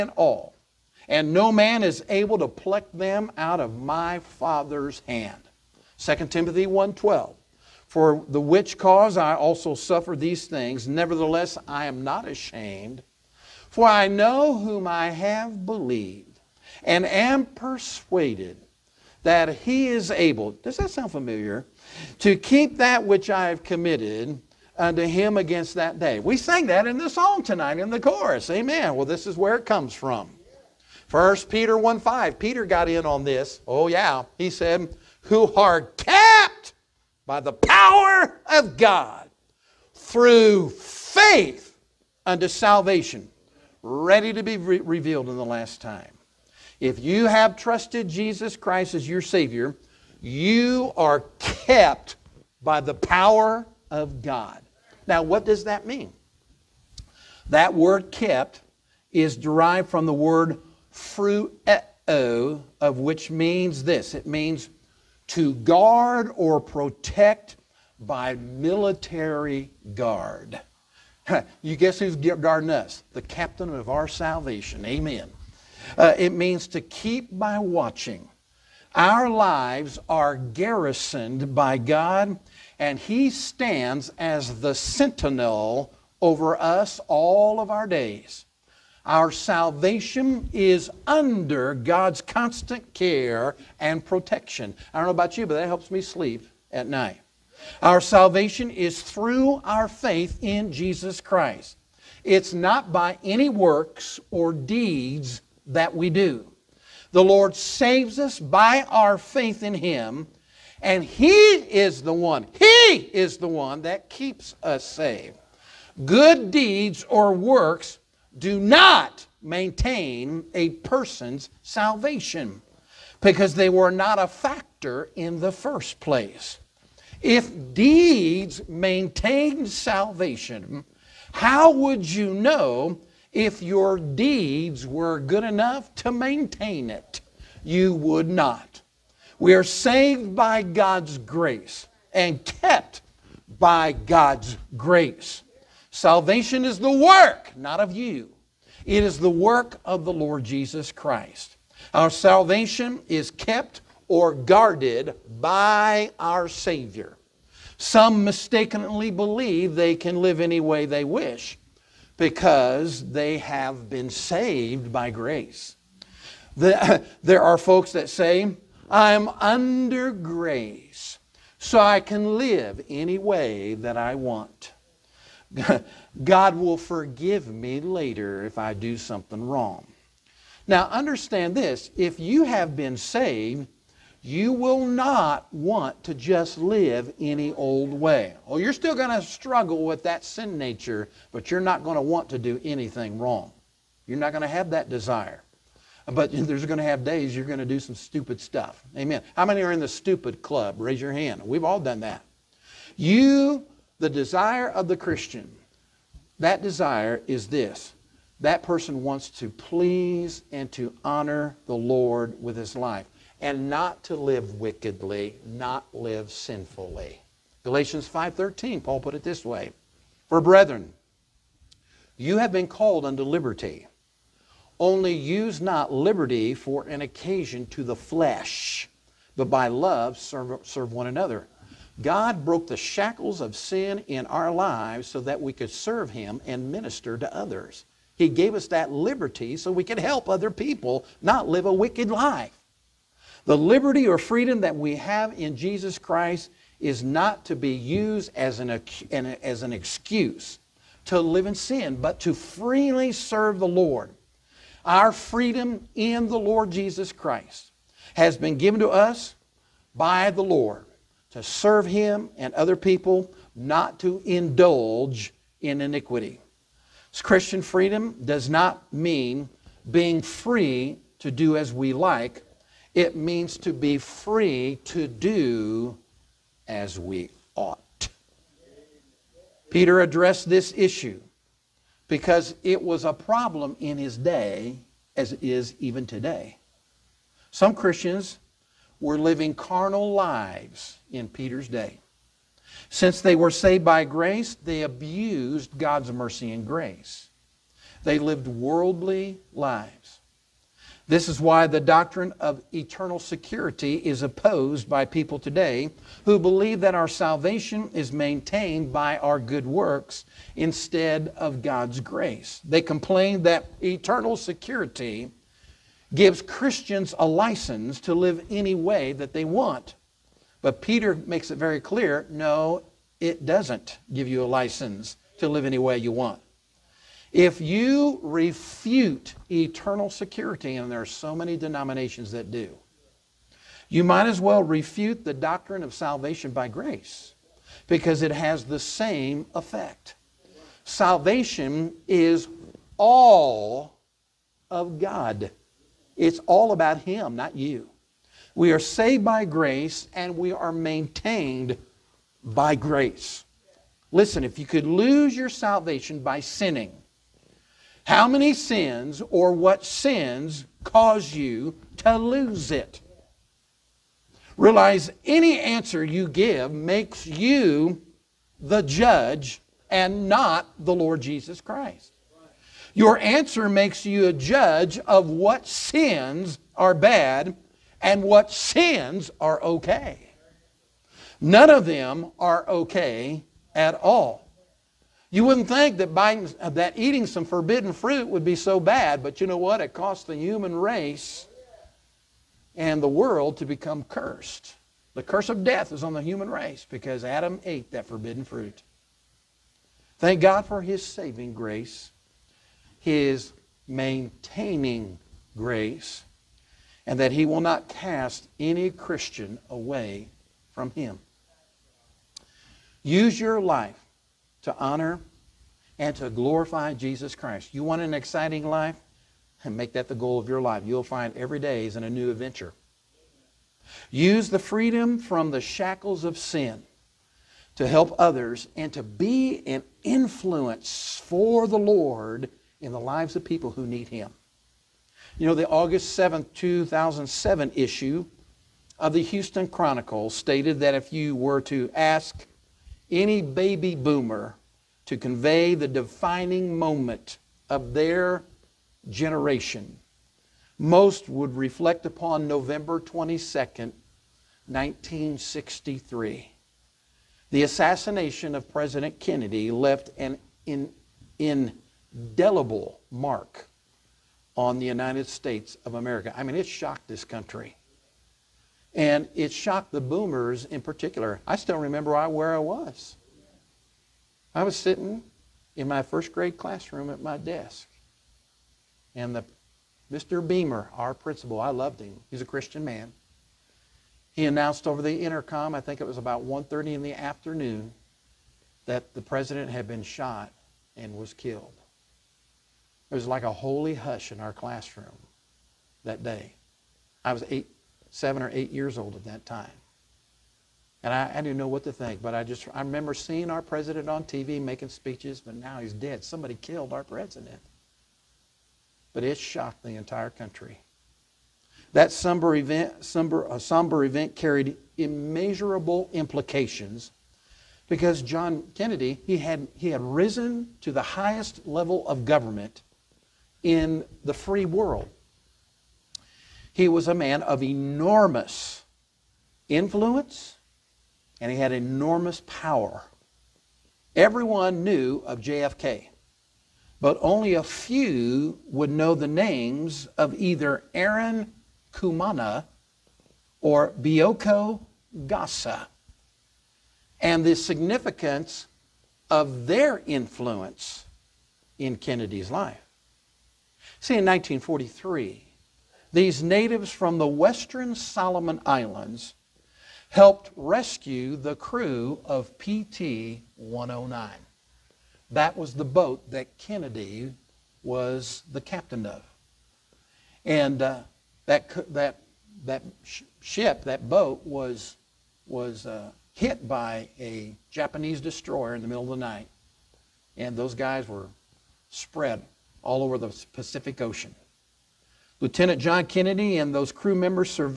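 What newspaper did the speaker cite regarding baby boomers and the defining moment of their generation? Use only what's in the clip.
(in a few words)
Houston Chronicle.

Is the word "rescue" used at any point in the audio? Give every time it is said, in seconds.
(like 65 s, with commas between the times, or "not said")
560 s.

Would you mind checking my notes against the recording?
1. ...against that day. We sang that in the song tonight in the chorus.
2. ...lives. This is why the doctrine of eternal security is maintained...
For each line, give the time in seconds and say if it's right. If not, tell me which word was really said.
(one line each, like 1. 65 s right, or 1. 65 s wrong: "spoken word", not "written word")
1. 25 s right
2. 299 s wrong: "opposed", not "maintained".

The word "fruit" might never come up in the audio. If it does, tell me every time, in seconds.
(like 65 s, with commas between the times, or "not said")
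387 s, 398 s.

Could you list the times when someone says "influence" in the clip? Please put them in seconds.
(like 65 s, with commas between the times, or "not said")
430 s, 529 s, 550 s.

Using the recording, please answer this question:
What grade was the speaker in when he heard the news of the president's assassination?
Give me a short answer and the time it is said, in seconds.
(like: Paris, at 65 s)
first grade, at 476 s.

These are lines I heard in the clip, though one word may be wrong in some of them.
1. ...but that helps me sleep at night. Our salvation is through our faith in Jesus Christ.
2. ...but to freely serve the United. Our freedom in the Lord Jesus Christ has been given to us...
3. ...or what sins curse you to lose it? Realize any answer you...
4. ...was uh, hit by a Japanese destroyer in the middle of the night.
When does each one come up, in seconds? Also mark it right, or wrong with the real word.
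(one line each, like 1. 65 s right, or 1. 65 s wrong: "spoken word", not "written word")
1. 95 s right
2. 251 s wrong: "Lord", not "United"
3. 359 s wrong: "cause", not "curse"
4. 575 s right.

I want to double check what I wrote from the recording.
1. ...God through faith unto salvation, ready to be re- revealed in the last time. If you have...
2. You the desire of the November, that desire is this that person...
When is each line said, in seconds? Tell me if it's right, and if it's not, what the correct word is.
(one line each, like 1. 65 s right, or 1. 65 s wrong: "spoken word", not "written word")
1. 38 s right
2. 202 s wrong: "Christian", not "November".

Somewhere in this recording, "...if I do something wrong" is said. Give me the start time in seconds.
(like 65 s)
178 s.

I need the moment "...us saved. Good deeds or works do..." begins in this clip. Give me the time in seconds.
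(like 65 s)
114 s.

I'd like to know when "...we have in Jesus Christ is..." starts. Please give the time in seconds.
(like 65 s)
244 s.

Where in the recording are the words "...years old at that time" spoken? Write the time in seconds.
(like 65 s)
498 s.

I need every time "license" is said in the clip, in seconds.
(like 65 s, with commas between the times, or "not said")
317 s, 324 s.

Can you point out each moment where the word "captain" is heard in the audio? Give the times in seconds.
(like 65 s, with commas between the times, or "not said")
73 s, 568 s.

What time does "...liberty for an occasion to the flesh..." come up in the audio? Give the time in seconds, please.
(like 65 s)
225 s.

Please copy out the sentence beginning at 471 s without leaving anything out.
I still remember where I was.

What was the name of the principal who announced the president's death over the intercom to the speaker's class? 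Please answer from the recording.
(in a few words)
Mr. Beamer.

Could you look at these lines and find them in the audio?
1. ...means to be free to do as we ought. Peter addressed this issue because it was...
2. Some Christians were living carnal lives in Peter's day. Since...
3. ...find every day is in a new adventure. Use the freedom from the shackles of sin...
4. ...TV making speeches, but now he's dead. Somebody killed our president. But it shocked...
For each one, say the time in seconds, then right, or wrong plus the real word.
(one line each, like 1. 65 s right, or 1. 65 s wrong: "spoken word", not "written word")
1. 273 s right
2. 287 s right
3. 421 s right
4. 504 s right.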